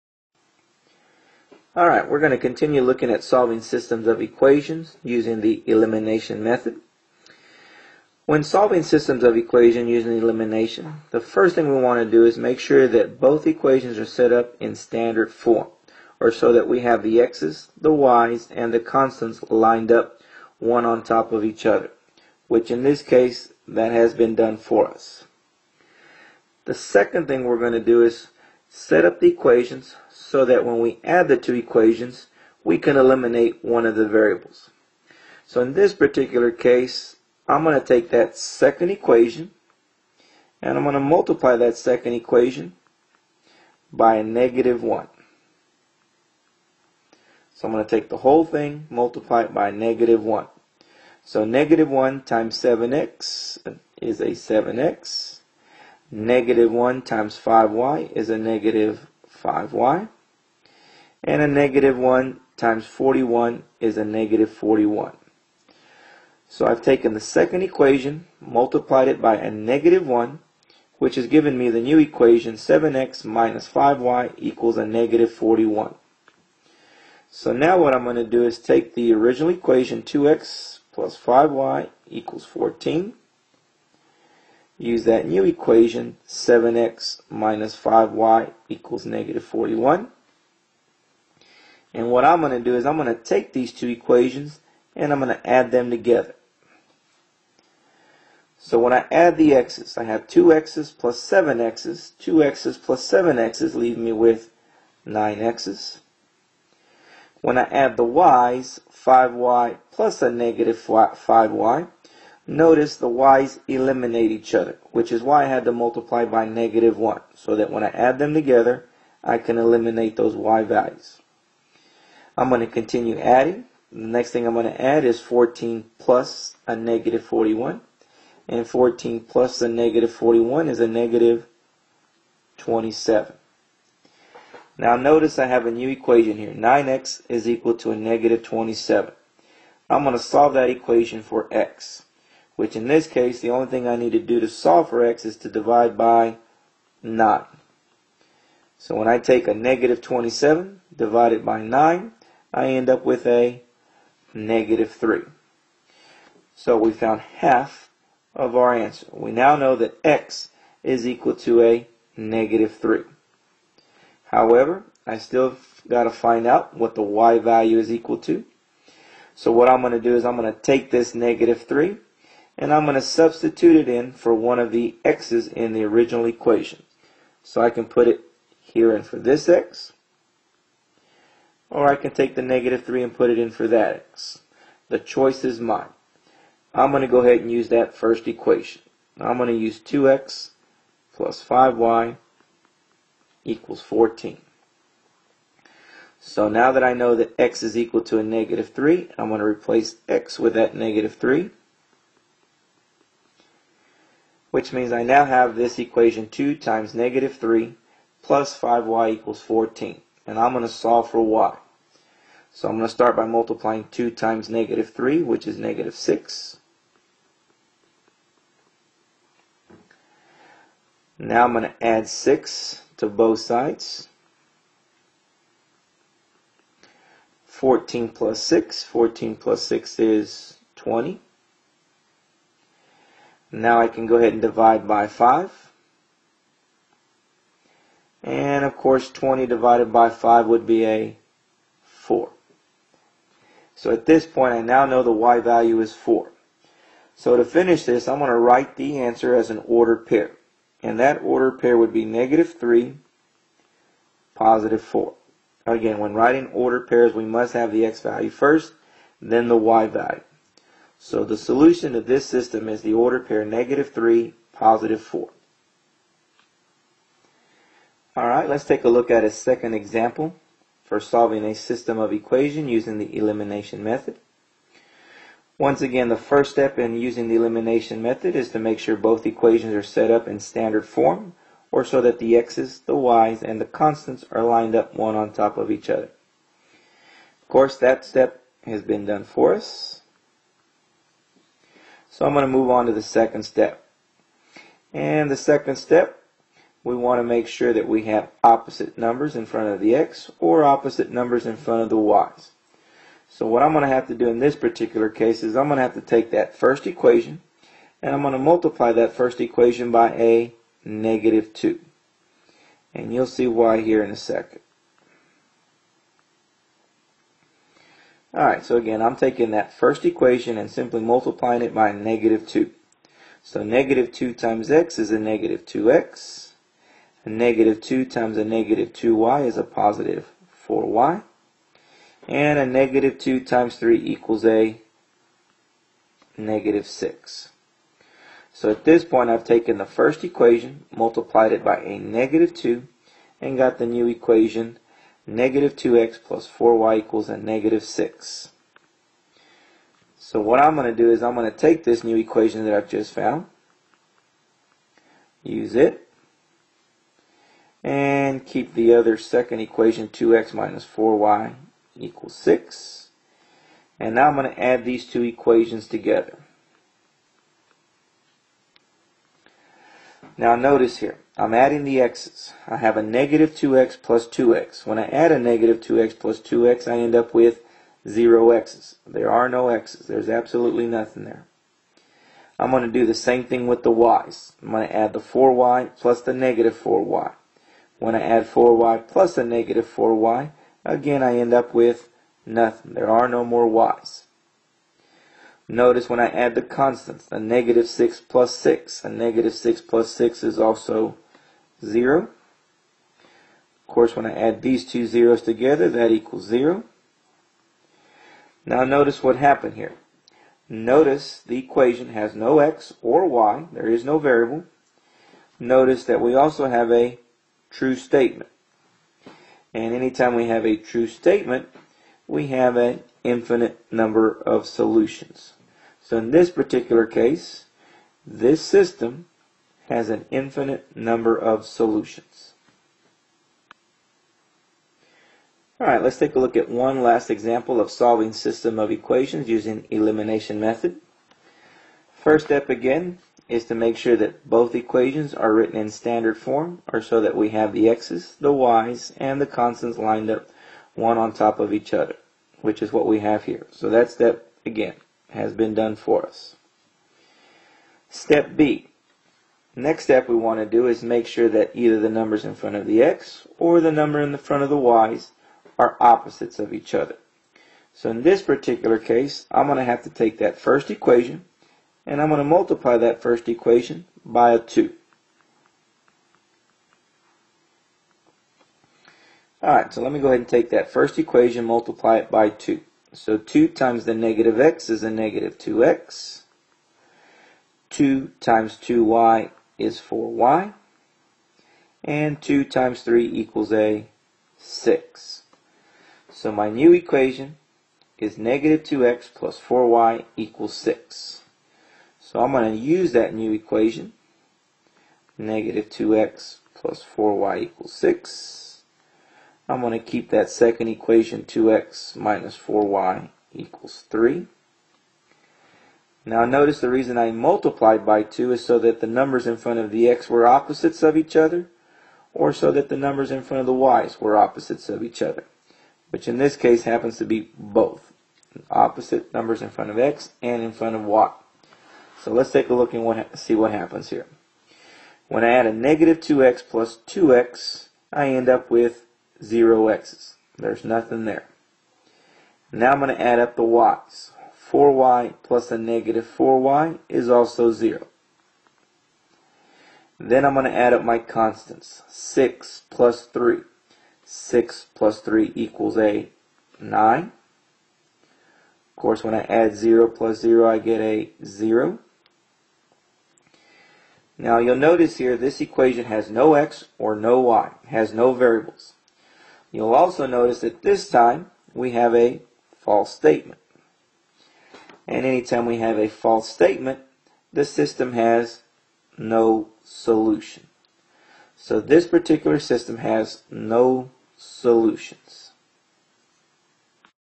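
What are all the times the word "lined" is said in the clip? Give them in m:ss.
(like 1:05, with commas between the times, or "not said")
0:19, 4:44, 7:29.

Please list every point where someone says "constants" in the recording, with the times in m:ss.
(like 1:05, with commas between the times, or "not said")
0:18, 4:43, 6:36, 7:29, 9:11.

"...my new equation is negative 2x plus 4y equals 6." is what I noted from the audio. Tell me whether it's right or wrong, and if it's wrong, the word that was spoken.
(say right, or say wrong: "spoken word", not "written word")
right.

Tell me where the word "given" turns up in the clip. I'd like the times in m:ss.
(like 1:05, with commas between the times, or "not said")
1:11.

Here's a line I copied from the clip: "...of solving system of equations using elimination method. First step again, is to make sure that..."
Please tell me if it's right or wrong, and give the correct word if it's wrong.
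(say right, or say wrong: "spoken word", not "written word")
right.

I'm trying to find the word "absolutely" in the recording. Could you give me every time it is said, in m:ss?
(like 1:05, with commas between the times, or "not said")
6:20.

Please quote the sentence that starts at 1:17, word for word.
So now what I'm going to do is take the original equation 2x plus 5y equals 14.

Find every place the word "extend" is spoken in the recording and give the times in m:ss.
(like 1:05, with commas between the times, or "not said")
not said.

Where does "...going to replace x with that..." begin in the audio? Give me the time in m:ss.
3:19.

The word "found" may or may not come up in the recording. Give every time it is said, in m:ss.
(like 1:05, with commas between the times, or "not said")
2:36, 5:53.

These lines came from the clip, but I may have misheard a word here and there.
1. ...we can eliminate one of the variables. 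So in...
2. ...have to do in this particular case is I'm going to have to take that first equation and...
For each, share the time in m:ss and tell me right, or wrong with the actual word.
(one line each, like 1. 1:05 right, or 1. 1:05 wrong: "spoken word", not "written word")
1. 0:32 right
2. 5:03 right.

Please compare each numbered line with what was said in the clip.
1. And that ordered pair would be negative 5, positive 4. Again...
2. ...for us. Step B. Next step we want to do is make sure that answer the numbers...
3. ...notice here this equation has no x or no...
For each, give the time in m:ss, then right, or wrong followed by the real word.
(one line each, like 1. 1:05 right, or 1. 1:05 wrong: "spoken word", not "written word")
1. 4:10 wrong: "3", not "5"
2. 7:35 wrong: "either", not "answer"
3. 9:24 right.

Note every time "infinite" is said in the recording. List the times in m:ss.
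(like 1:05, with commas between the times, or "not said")
7:03, 7:10.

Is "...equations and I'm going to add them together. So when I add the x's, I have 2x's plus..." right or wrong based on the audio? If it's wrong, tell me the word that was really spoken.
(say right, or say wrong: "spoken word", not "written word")
right.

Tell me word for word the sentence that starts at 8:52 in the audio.
So let's take a look and what, see what happens here.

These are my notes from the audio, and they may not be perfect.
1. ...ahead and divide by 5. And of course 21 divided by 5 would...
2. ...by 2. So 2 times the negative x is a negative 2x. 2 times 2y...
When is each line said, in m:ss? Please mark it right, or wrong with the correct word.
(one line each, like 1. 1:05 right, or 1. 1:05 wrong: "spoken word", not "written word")
1. 3:54 wrong: "20", not "21"
2. 8:02 right.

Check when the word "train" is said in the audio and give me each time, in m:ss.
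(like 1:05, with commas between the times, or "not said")
not said.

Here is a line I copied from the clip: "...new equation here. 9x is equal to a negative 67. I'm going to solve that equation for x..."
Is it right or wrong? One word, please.
wrong.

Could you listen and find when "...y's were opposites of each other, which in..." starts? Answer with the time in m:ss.
8:43.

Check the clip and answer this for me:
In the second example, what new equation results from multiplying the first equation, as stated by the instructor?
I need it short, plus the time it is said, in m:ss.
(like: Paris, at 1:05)
-2x + 4y = -6, at 5:45.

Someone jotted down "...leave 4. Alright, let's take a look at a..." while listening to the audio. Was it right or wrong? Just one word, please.
wrong.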